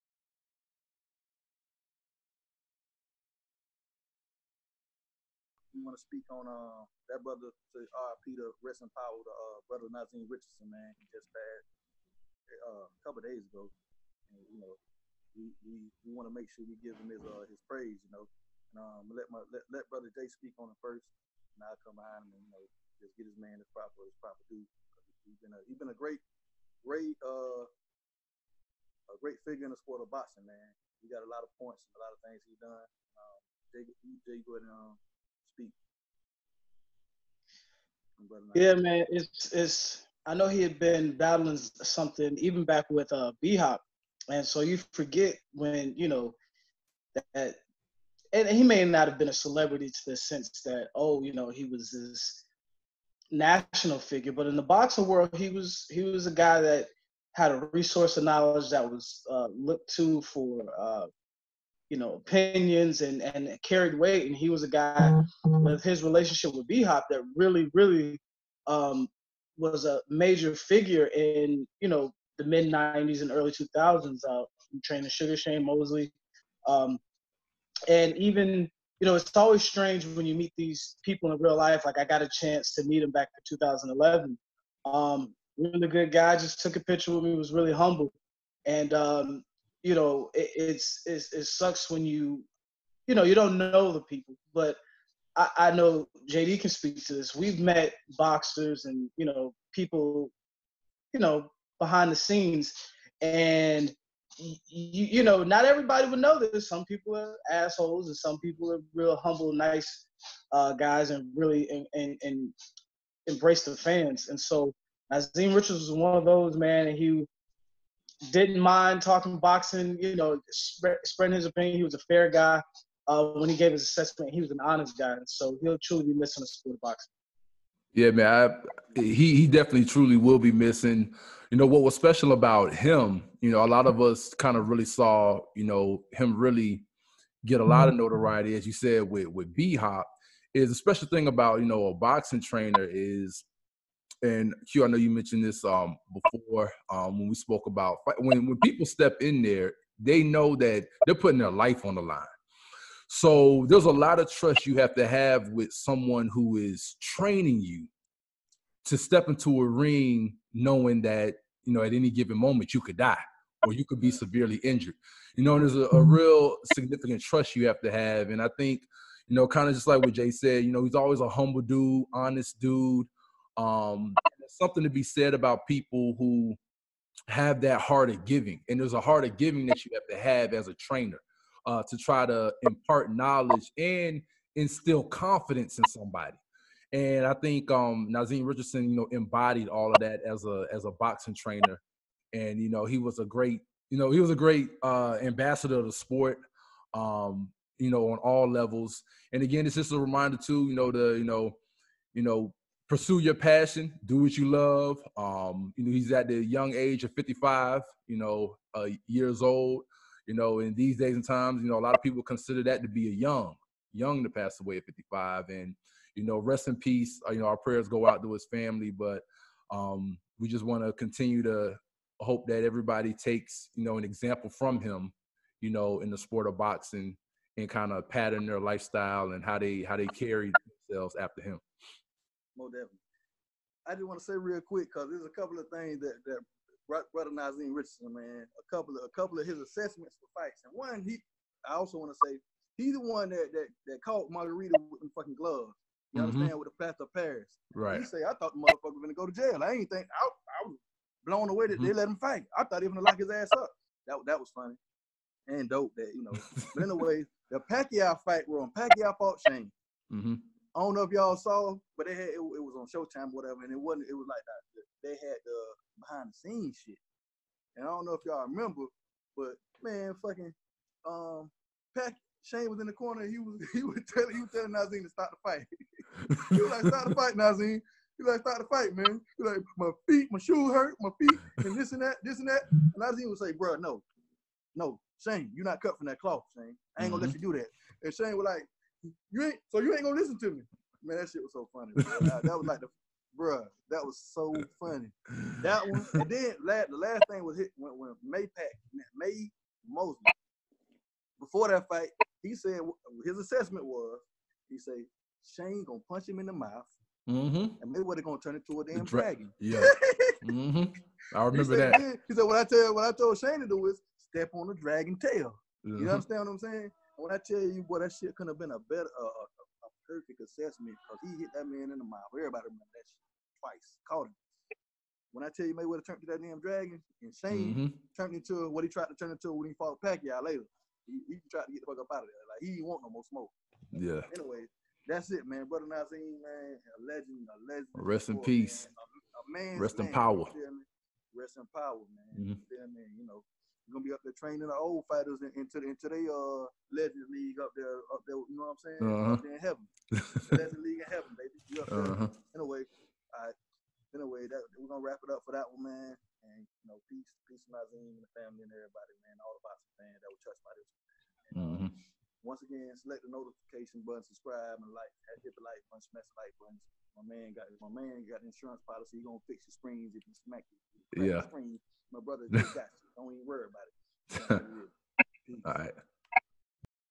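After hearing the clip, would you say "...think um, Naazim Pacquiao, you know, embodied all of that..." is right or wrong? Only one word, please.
wrong.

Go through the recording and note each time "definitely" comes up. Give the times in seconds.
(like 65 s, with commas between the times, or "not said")
129 s, 232 s.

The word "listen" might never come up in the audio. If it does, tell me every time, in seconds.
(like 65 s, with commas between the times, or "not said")
290 s.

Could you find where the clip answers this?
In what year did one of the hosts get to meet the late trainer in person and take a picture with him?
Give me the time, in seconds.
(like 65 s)
83 s.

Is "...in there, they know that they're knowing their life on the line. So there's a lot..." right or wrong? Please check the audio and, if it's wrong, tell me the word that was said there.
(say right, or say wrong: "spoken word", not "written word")
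wrong: "putting", not "knowing".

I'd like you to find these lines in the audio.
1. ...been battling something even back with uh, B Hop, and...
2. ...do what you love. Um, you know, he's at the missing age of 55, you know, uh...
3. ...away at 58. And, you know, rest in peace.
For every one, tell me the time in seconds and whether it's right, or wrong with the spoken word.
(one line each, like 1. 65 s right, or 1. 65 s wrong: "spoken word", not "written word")
1. 40 s right
2. 204 s wrong: "young", not "missing"
3. 214 s wrong: "55", not "58".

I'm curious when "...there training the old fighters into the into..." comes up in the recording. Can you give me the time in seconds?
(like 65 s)
344 s.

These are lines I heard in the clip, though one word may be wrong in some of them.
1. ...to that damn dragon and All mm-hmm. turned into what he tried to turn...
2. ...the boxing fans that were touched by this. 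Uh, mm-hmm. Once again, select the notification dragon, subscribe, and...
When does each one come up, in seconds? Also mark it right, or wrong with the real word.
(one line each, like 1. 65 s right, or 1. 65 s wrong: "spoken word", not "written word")
1. 326 s wrong: "Shane", not "All"
2. 359 s wrong: "button", not "dragon".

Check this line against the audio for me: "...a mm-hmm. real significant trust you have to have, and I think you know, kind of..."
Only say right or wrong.
right.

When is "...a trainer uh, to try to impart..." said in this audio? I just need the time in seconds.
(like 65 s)
180 s.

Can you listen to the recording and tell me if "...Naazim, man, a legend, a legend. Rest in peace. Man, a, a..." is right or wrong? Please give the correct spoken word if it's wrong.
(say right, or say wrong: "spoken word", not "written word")
right.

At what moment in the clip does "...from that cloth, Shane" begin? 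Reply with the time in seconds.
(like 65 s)
285 s.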